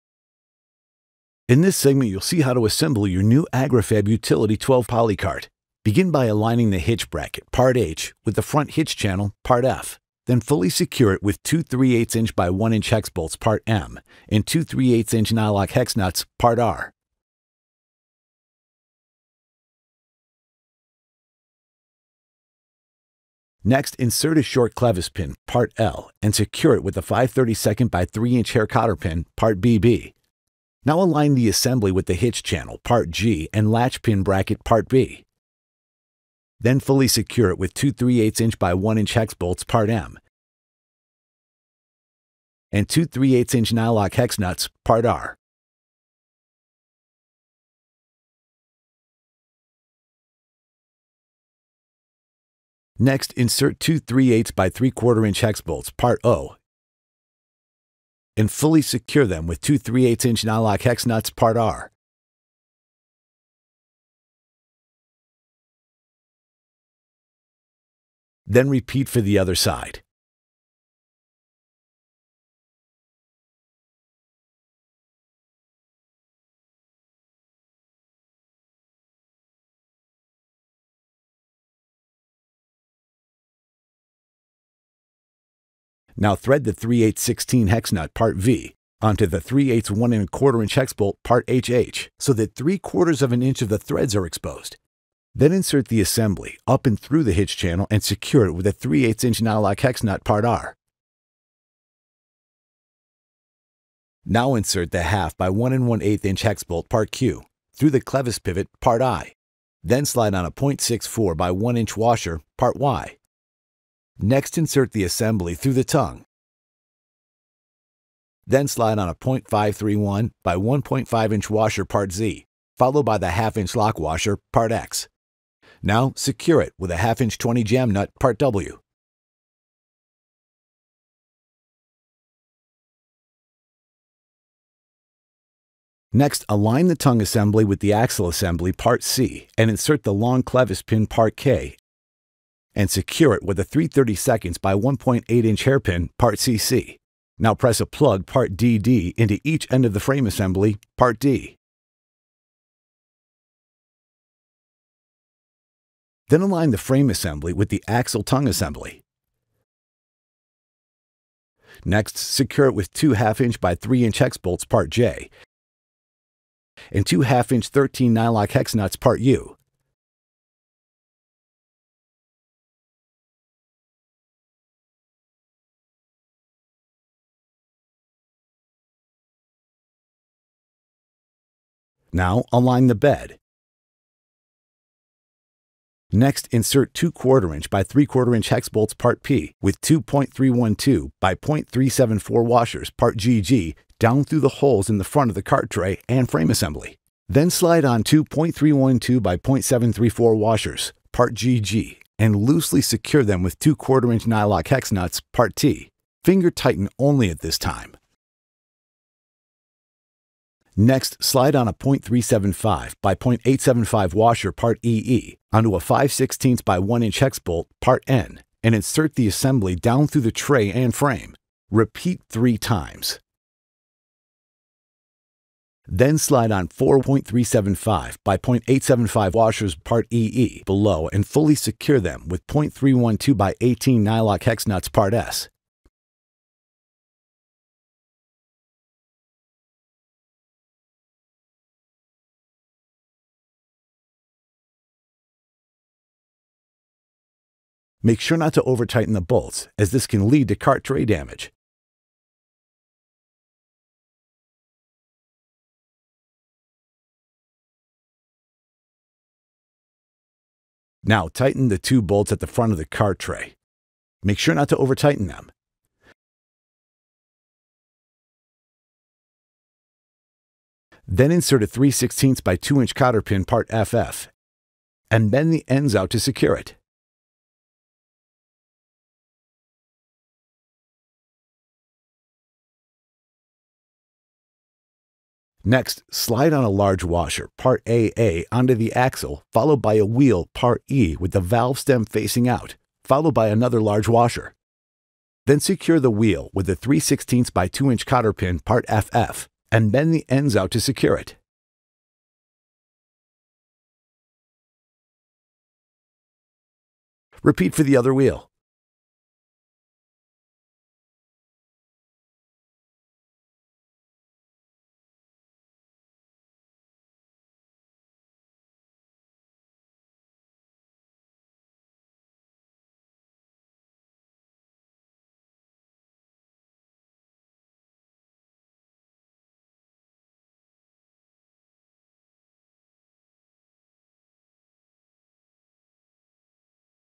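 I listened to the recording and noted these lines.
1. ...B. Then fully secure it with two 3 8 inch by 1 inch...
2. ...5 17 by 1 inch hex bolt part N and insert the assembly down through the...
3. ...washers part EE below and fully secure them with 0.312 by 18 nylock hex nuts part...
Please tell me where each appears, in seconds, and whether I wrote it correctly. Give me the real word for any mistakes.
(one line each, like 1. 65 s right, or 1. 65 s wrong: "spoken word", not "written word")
1. 34 s right
2. 215 s wrong: "16", not "17"
3. 229 s right.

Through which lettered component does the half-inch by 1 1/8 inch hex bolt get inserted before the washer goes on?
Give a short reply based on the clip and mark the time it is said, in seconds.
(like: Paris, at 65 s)
Clevis pivot, part I, at 108 s.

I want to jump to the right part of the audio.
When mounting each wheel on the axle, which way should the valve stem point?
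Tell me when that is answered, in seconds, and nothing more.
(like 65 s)
292 s.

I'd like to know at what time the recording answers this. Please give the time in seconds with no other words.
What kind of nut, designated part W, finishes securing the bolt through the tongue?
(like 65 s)
126 s.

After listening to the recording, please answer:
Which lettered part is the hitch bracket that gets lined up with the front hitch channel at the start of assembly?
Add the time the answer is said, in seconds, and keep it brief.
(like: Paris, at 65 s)
Part H, at 7 s.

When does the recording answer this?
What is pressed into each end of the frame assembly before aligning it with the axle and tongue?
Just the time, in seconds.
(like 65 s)
147 s.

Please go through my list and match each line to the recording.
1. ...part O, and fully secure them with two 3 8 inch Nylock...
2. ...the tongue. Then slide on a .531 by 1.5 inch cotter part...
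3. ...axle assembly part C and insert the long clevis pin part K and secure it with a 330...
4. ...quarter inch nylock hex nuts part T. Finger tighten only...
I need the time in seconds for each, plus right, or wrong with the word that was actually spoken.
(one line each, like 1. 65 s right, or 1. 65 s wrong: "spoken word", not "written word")
1. 55 s right
2. 115 s wrong: "washer", not "cotter"
3. 137 s right
4. 203 s right.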